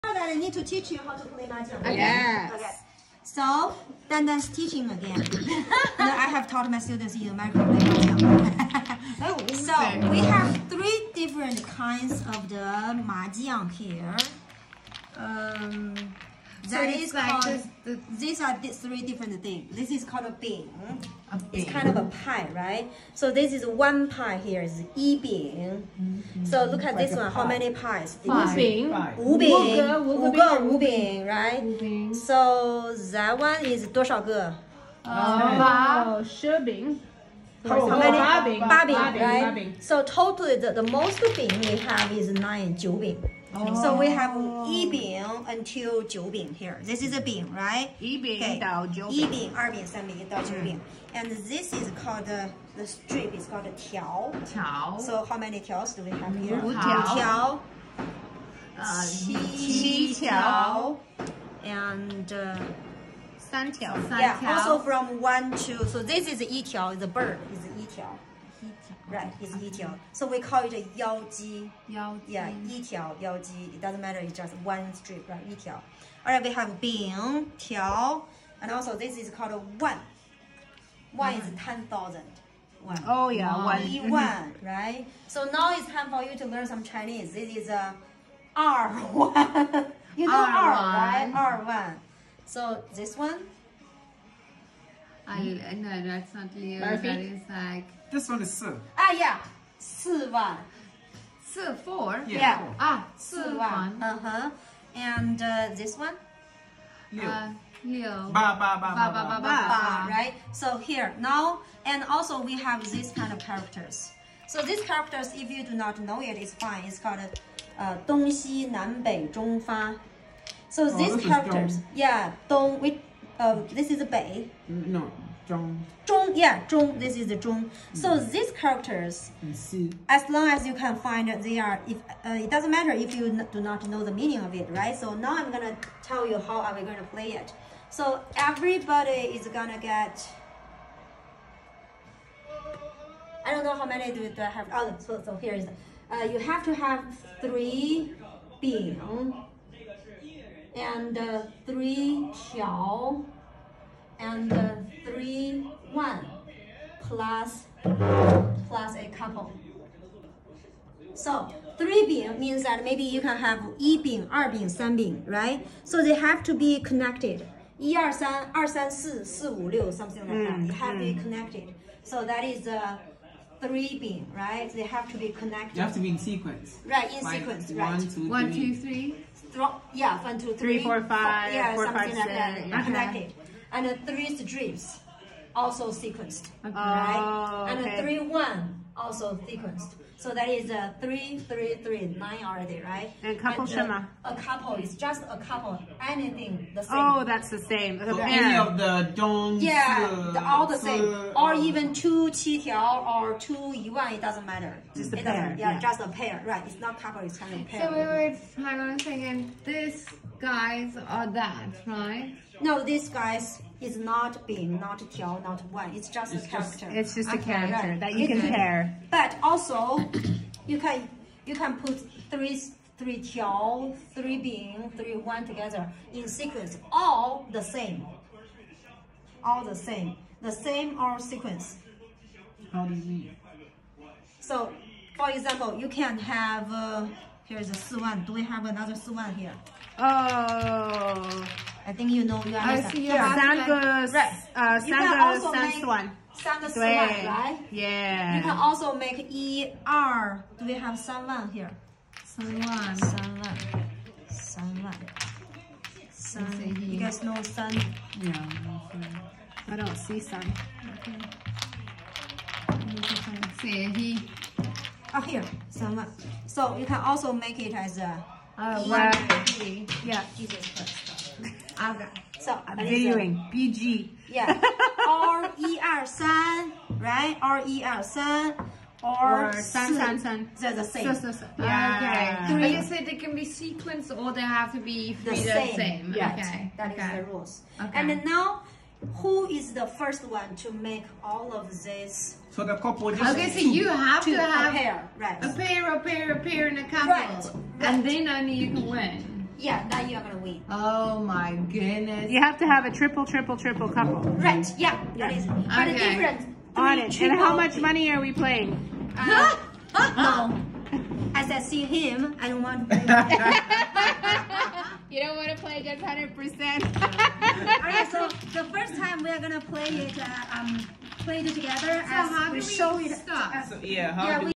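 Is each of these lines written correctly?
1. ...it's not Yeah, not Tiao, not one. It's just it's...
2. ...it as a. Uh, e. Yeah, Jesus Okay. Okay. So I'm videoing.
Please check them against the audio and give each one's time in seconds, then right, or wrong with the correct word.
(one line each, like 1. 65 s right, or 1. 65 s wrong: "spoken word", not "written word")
1. 213 s wrong: "Bing", not "Yeah"
2. 267 s wrong: "Christ", not "Okay".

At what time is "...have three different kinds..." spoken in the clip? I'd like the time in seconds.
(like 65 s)
10 s.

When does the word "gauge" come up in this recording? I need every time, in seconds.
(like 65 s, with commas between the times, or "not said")
not said.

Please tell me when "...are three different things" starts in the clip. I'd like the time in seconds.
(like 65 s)
18 s.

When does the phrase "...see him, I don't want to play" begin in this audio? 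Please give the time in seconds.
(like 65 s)
311 s.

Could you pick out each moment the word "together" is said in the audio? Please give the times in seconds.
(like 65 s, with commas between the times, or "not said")
225 s, 321 s.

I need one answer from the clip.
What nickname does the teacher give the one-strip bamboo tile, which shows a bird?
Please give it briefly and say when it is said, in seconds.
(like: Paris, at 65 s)
yao ji, at 70 s.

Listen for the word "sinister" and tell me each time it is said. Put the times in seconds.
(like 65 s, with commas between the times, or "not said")
not said.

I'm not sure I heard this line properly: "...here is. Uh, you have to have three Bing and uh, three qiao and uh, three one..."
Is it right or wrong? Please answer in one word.
right.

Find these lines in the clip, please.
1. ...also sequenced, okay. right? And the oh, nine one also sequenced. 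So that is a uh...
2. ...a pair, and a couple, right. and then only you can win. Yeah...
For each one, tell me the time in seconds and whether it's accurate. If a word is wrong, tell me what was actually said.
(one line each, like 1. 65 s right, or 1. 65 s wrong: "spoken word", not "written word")
1. 185 s wrong: "three", not "nine"
2. 296 s right.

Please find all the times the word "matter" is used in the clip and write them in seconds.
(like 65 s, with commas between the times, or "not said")
73 s, 132 s, 204 s.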